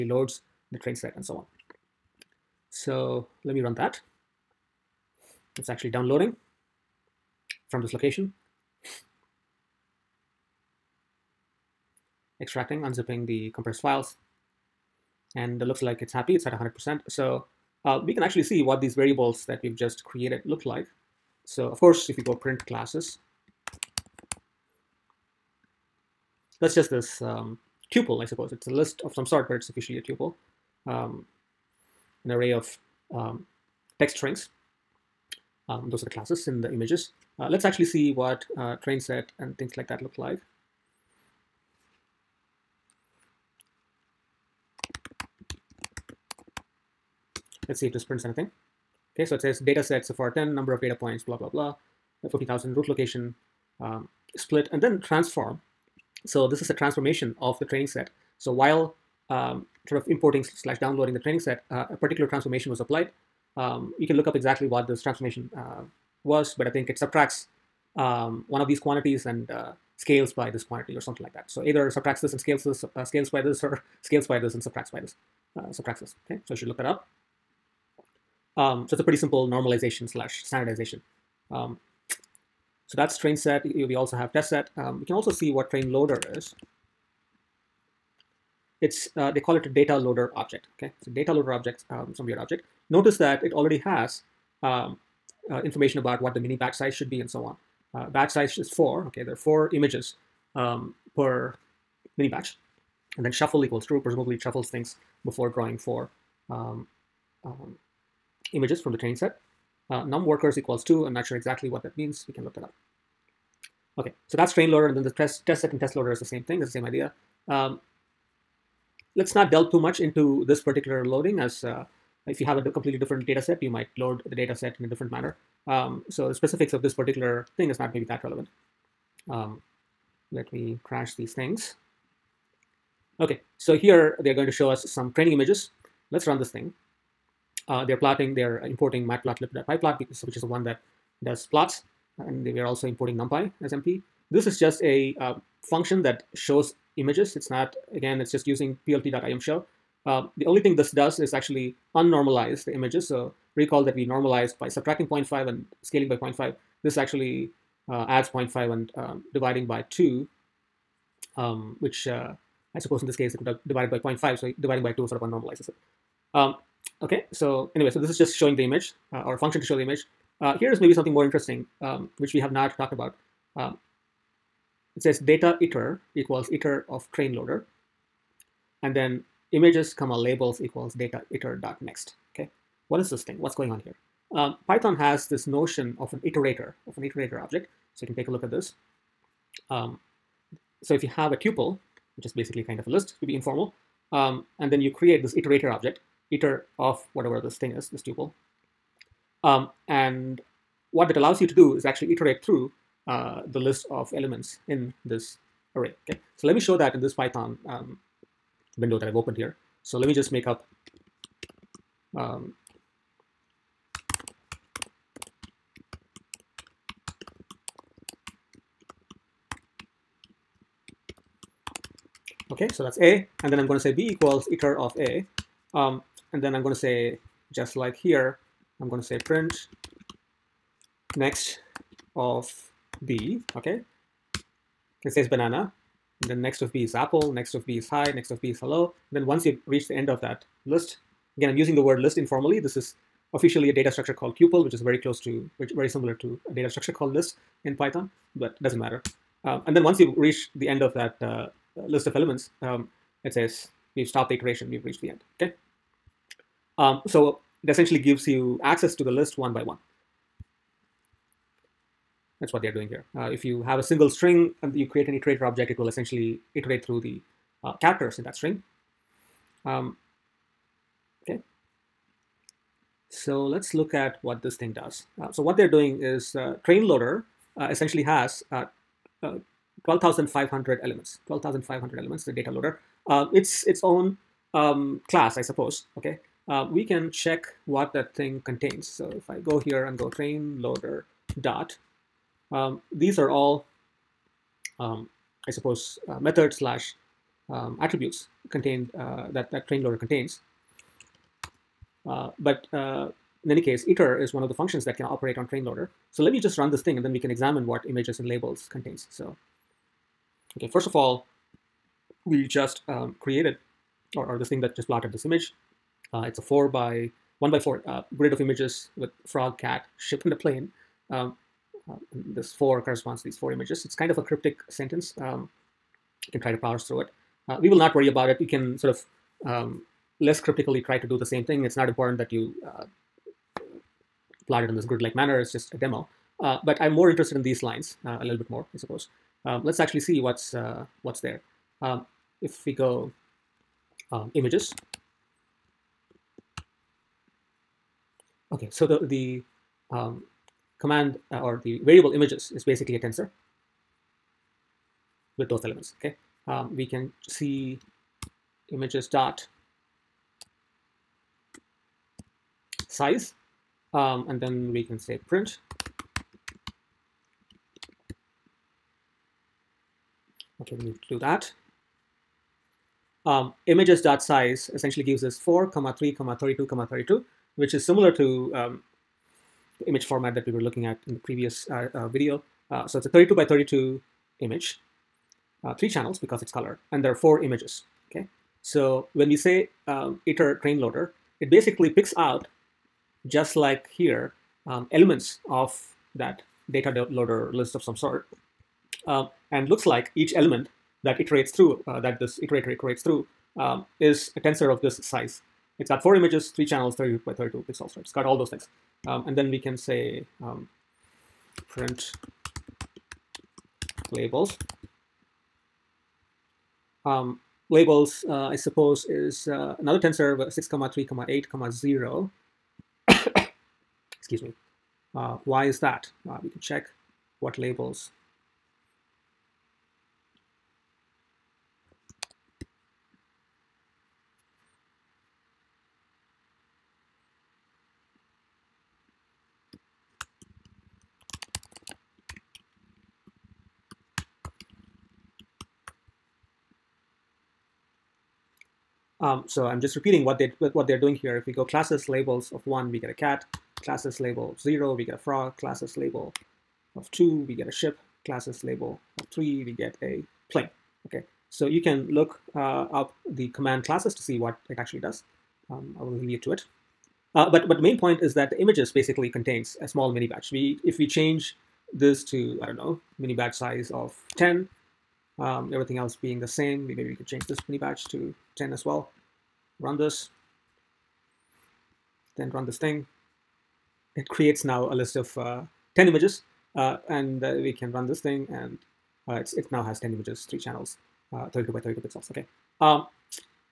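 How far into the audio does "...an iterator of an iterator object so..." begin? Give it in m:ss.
3:06.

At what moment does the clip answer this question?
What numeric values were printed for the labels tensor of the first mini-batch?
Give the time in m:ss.
7:00.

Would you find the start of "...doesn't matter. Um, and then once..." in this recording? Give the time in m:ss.
4:08.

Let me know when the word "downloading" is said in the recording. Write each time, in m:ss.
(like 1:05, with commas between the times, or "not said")
0:05, 1:00.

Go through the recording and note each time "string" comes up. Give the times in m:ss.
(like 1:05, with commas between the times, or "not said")
0:34, 4:24, 4:28.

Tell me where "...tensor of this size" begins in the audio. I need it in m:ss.
6:44.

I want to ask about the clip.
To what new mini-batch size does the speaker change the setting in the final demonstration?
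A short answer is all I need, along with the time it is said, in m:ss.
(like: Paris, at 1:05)
10, at 7:53.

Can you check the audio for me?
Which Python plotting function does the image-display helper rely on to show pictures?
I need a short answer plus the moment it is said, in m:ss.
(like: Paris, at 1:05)
plt.imshow, at 2:28.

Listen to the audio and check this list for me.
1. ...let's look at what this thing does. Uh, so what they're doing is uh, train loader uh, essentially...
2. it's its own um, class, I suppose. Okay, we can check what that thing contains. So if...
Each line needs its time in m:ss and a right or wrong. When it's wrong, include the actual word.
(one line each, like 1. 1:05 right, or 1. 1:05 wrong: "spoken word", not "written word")
1. 4:33 right
2. 4:43 right.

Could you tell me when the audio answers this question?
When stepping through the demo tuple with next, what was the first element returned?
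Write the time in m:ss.
3:55.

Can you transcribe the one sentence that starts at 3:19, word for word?
Um, and what that allows you to do is actually iterate through uh, the list of elements in this array.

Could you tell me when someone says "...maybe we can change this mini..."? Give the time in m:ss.
7:56.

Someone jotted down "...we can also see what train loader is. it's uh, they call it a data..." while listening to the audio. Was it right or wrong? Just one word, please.
right.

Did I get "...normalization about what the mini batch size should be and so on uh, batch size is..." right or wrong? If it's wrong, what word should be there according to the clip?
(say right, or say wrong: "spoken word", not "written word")
wrong: "information", not "normalization".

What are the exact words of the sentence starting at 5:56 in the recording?
Okay, um, we can see images dot size um, and then we can say print Okay, we need to do that.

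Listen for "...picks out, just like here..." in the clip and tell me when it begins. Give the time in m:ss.
6:31.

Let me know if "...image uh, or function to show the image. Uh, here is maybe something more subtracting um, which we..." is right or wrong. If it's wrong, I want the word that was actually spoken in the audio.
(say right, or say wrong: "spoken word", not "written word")
wrong: "interesting", not "subtracting".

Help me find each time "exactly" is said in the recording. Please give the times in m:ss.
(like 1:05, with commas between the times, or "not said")
1:04, 1:51.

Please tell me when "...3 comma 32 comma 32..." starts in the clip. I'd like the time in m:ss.
6:15.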